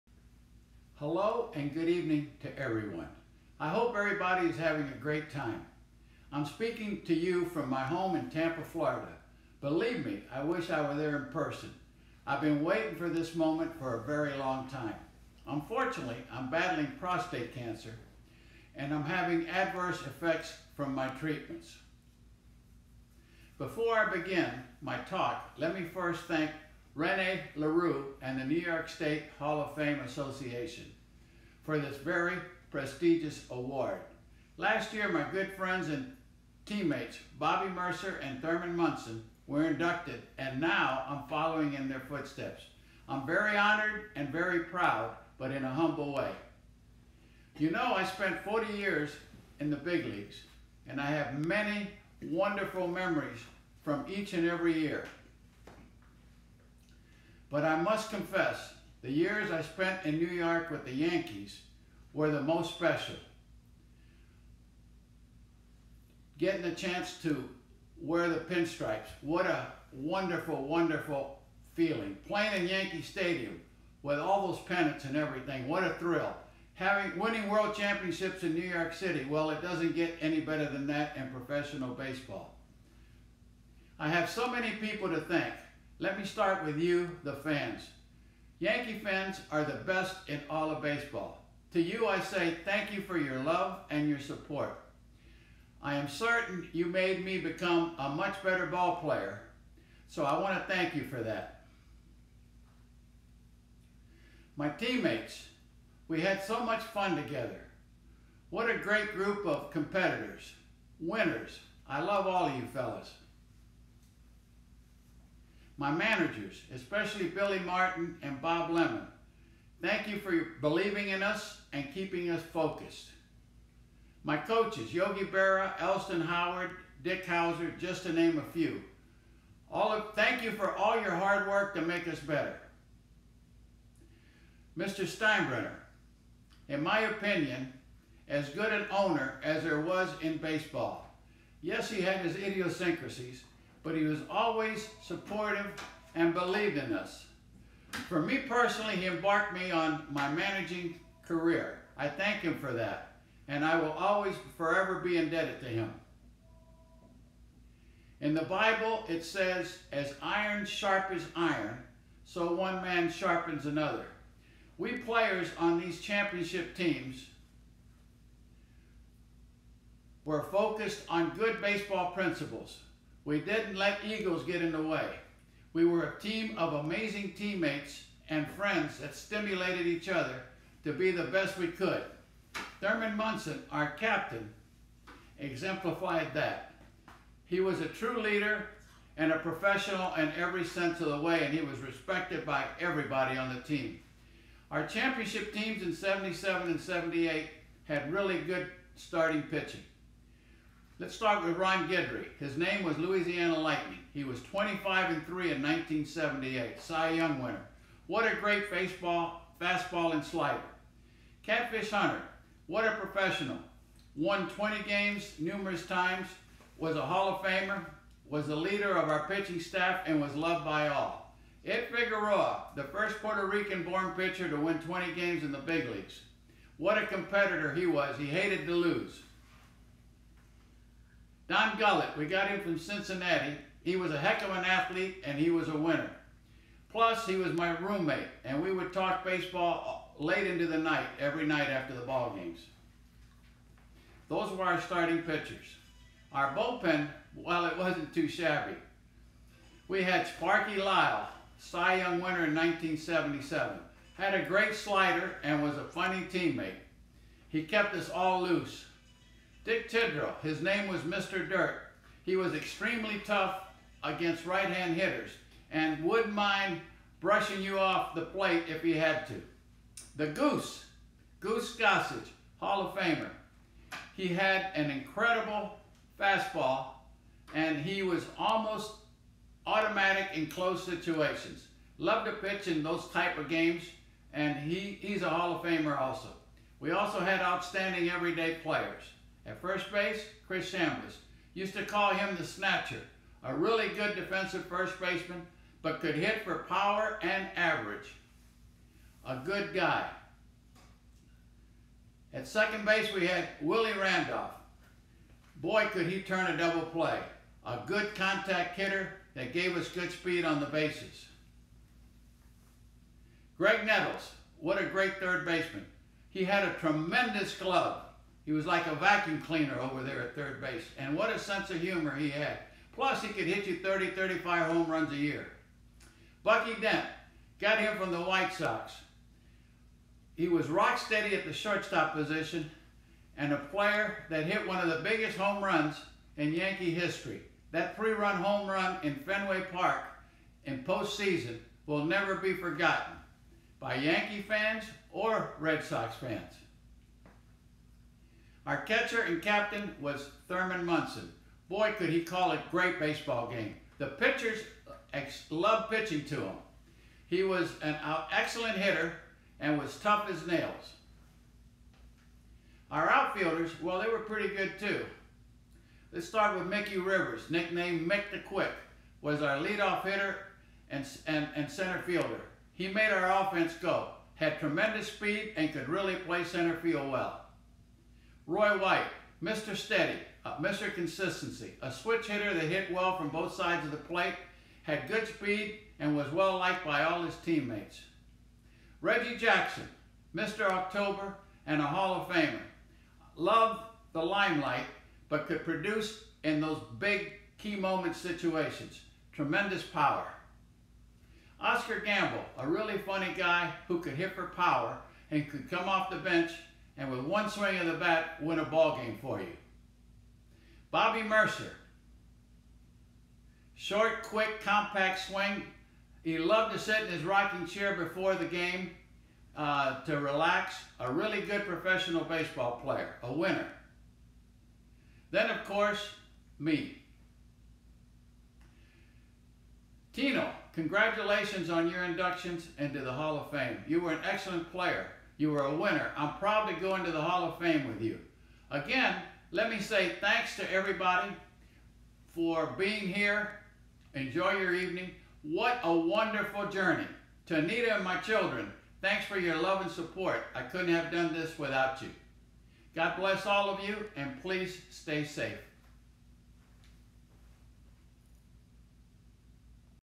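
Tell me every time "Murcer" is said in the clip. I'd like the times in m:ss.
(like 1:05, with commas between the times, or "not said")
0:37, 6:51.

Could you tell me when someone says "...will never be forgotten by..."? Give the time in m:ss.
5:41.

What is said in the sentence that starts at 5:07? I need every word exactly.
A good contact hitter that gave us good speed on the bases.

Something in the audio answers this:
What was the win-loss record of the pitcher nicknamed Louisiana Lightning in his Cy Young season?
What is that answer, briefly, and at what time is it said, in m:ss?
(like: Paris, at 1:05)
25 and 3, at 3:24.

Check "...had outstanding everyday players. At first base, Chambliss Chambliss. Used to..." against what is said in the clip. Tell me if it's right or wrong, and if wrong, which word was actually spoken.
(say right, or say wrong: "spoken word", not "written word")
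wrong: "Chris", not "Chambliss".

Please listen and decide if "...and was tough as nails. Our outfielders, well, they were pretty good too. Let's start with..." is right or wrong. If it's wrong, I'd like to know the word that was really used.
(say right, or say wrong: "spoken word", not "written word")
right.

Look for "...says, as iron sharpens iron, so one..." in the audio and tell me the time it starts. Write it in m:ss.
2:39.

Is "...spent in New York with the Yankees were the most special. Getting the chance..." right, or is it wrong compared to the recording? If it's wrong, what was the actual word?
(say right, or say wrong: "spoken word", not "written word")
right.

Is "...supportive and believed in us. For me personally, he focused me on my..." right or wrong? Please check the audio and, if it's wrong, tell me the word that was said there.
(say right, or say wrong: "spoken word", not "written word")
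wrong: "embarked", not "focused".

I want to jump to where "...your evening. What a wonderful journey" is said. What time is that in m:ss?
7:24.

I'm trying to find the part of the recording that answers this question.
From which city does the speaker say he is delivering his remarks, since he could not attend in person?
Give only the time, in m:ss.
0:08.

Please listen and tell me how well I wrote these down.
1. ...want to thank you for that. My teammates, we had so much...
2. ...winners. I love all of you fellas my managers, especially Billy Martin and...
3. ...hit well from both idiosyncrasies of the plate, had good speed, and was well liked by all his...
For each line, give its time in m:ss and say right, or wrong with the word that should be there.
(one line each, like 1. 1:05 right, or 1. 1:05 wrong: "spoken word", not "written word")
1. 1:40 right
2. 1:50 right
3. 6:22 wrong: "sides", not "idiosyncrasies".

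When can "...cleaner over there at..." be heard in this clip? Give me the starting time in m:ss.
5:19.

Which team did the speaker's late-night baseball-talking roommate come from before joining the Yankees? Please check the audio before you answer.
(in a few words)
Cincinnati.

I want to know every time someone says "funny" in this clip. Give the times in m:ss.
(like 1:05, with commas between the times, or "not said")
4:15, 6:42.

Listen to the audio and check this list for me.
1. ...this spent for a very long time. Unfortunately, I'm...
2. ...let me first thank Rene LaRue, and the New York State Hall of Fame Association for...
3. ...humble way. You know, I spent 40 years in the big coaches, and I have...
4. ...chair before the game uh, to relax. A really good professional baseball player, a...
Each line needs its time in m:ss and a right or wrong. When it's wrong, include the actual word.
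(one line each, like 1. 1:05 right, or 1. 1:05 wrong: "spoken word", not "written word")
1. 0:13 wrong: "moment", not "spent"
2. 0:25 right
3. 0:45 wrong: "leagues", not "coaches"
4. 6:57 right.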